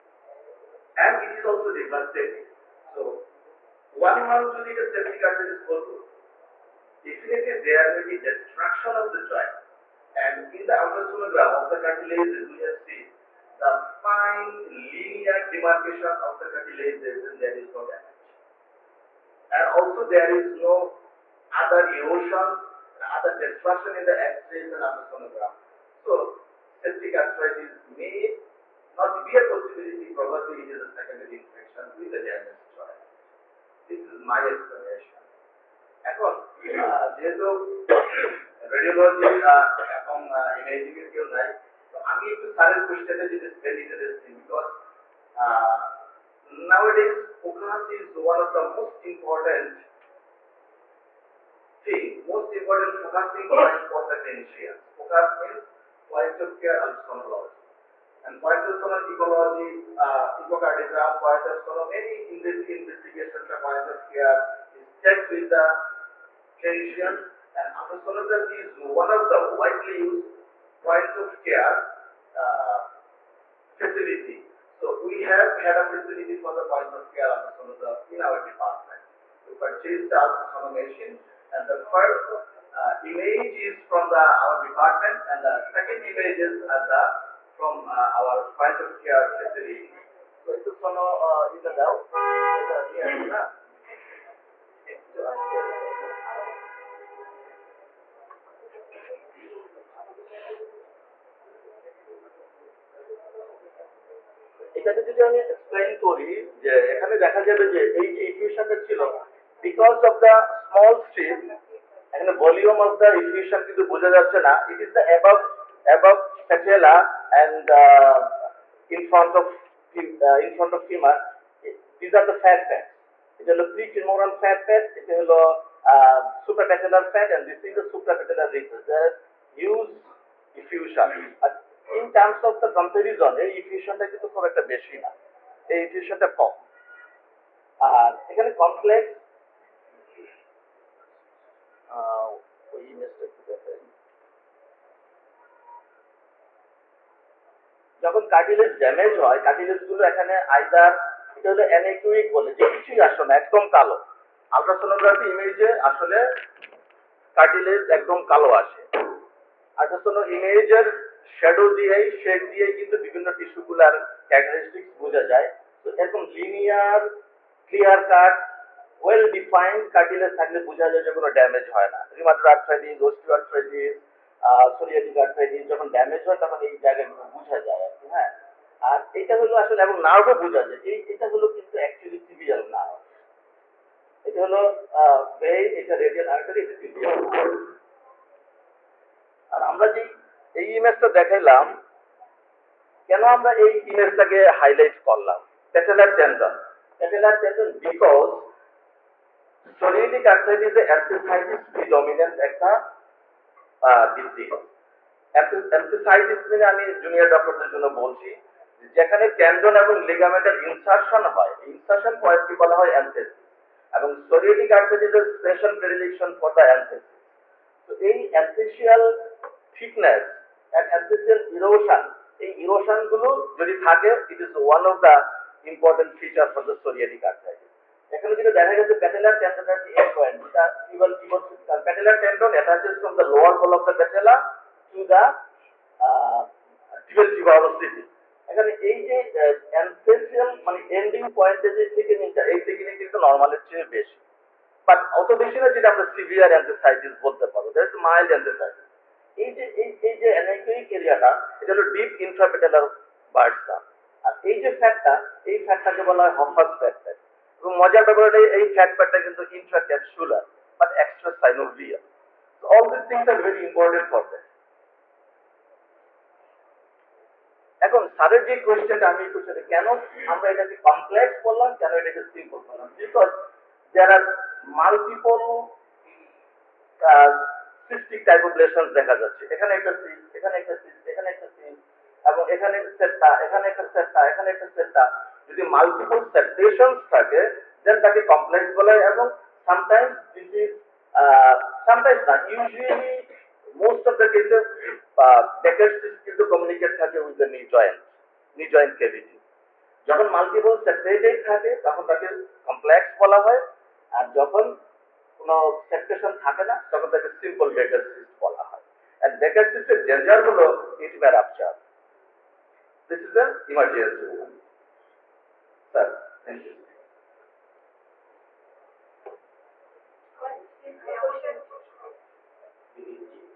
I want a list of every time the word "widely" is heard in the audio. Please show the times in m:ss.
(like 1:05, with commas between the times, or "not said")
1:09.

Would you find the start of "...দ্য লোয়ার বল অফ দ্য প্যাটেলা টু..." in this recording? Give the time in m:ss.
3:53.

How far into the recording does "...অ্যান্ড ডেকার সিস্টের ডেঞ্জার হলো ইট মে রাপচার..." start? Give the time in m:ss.
5:09.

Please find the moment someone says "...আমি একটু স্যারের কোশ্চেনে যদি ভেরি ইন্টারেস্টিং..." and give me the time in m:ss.
0:42.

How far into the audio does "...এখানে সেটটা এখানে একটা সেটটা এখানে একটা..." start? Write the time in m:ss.
4:42.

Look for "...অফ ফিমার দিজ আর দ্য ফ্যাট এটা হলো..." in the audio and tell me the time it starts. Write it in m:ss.
2:00.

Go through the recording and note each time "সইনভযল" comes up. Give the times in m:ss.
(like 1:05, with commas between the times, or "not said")
4:21.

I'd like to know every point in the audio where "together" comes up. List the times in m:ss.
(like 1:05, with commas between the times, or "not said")
2:23.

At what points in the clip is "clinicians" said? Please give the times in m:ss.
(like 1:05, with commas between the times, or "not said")
0:54, 1:06.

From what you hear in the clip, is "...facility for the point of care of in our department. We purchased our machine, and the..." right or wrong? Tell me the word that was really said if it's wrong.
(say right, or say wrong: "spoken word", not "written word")
right.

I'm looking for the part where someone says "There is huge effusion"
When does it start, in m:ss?
2:08.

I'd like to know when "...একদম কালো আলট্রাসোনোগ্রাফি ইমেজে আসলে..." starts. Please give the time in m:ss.
2:33.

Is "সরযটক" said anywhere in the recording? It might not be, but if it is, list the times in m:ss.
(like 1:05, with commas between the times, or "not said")
2:54, 3:34, 3:46.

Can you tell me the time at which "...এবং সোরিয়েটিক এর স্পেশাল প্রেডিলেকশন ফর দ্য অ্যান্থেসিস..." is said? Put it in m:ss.
3:33.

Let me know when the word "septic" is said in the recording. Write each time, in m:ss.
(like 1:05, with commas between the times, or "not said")
0:04, 0:26.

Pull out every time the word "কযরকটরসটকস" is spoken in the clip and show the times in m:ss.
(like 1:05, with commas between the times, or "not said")
2:44.